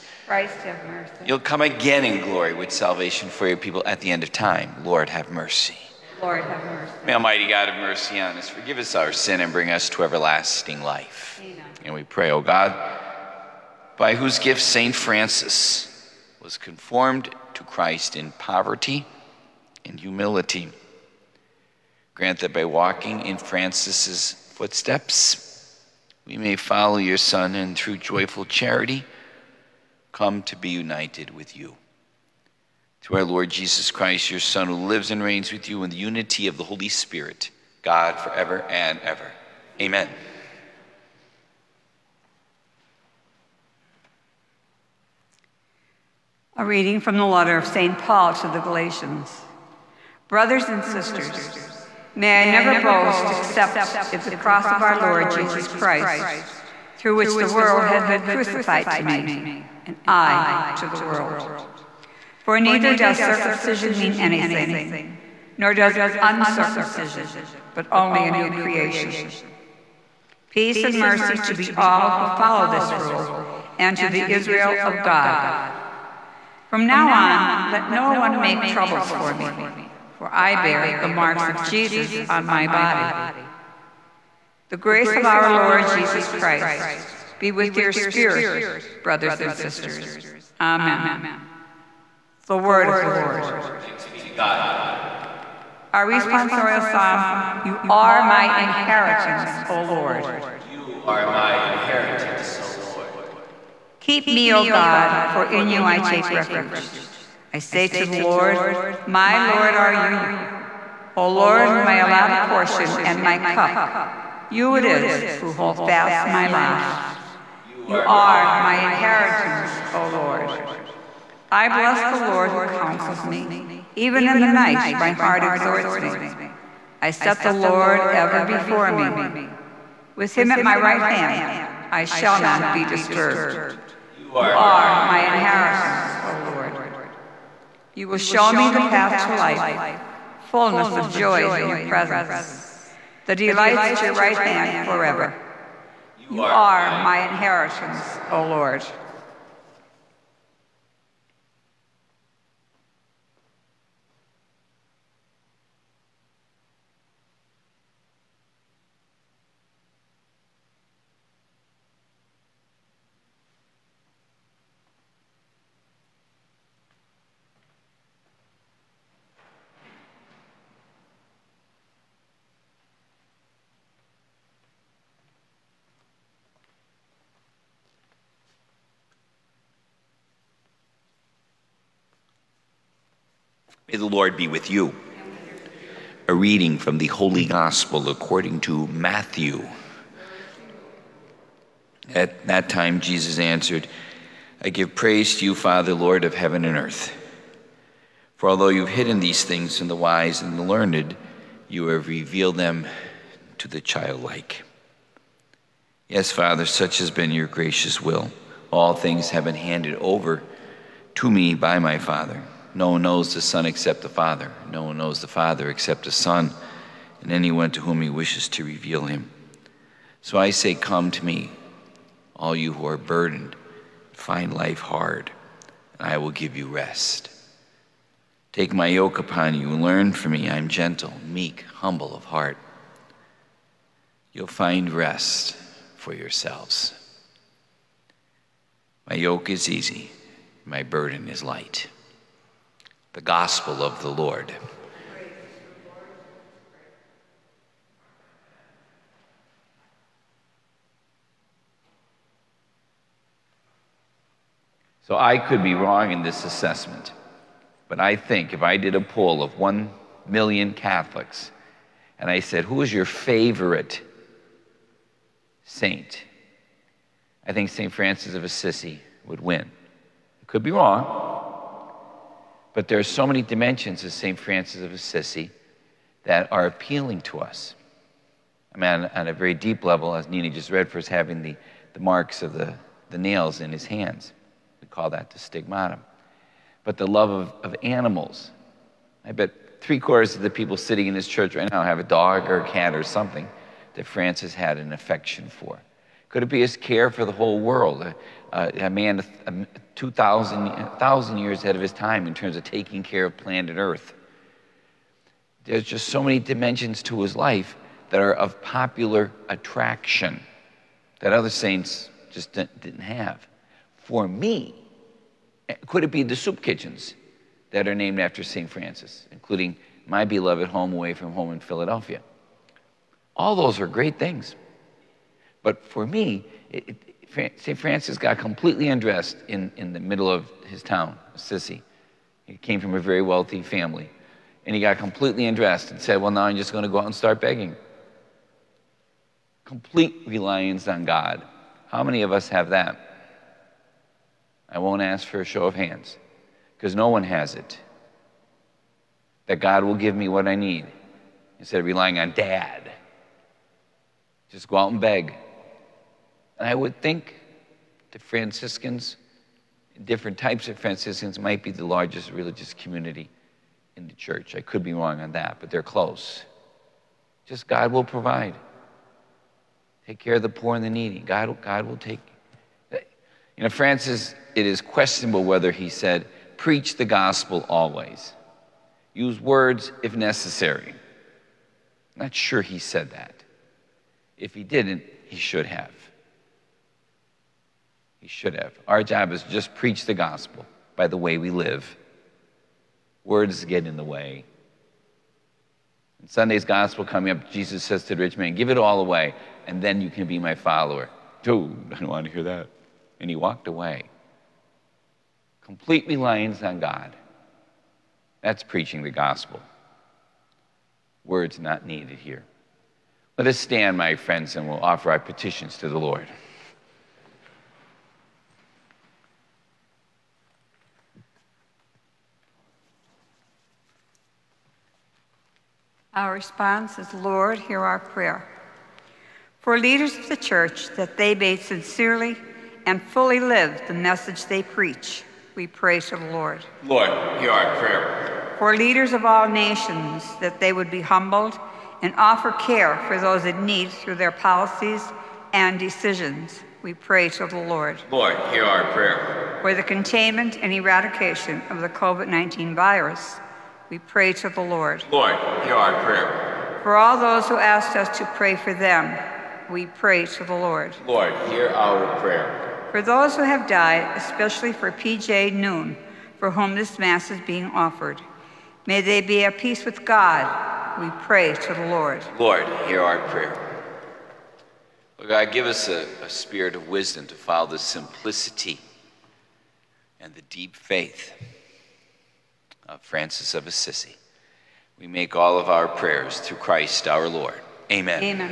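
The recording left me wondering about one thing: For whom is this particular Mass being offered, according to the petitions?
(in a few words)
P.J. Noon.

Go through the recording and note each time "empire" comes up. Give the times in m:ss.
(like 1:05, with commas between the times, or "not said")
not said.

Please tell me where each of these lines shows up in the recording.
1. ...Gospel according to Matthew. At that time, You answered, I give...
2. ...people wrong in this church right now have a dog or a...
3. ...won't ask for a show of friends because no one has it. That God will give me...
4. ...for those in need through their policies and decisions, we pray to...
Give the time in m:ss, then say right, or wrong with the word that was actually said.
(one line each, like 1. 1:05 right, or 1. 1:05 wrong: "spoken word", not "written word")
1. 3:07 wrong: "Jesus", not "You"
2. 4:50 wrong: "sitting", not "wrong"
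3. 5:44 wrong: "hands", not "friends"
4. 7:23 right.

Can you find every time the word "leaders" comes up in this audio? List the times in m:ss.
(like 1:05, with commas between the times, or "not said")
7:09, 7:18.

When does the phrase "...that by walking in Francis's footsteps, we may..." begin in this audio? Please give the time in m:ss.
0:22.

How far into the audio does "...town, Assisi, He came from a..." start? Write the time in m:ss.
5:30.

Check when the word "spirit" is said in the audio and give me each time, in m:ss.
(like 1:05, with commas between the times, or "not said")
0:36, 1:27, 7:56.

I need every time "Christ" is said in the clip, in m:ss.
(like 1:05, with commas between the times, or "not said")
0:00, 0:17, 0:33, 0:55, 1:26, 8:06.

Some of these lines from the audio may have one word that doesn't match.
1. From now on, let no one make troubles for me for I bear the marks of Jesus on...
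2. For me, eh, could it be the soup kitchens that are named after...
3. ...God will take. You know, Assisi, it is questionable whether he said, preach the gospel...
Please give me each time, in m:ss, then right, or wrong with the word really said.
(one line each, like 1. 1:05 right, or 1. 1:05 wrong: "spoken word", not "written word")
1. 1:16 right
2. 5:13 right
3. 6:11 wrong: "Francis", not "Assisi".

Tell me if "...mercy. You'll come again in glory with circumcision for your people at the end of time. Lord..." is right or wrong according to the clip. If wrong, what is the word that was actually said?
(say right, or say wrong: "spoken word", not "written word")
wrong: "salvation", not "circumcision".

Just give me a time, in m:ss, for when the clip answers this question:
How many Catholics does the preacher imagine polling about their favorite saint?
4:19.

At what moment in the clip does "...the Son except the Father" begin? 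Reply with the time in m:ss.
3:33.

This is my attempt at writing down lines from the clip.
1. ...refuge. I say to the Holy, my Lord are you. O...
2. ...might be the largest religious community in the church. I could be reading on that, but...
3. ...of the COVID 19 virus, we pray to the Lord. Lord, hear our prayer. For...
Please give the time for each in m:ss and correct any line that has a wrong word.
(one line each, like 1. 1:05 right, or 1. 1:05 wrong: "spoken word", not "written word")
1. 1:46 wrong: "Lord", not "Holy"
2. 6:01 wrong: "wrong", not "reading"
3. 7:31 right.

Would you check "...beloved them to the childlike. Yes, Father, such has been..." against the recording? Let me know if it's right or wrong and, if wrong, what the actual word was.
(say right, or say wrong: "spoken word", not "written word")
wrong: "revealed", not "beloved".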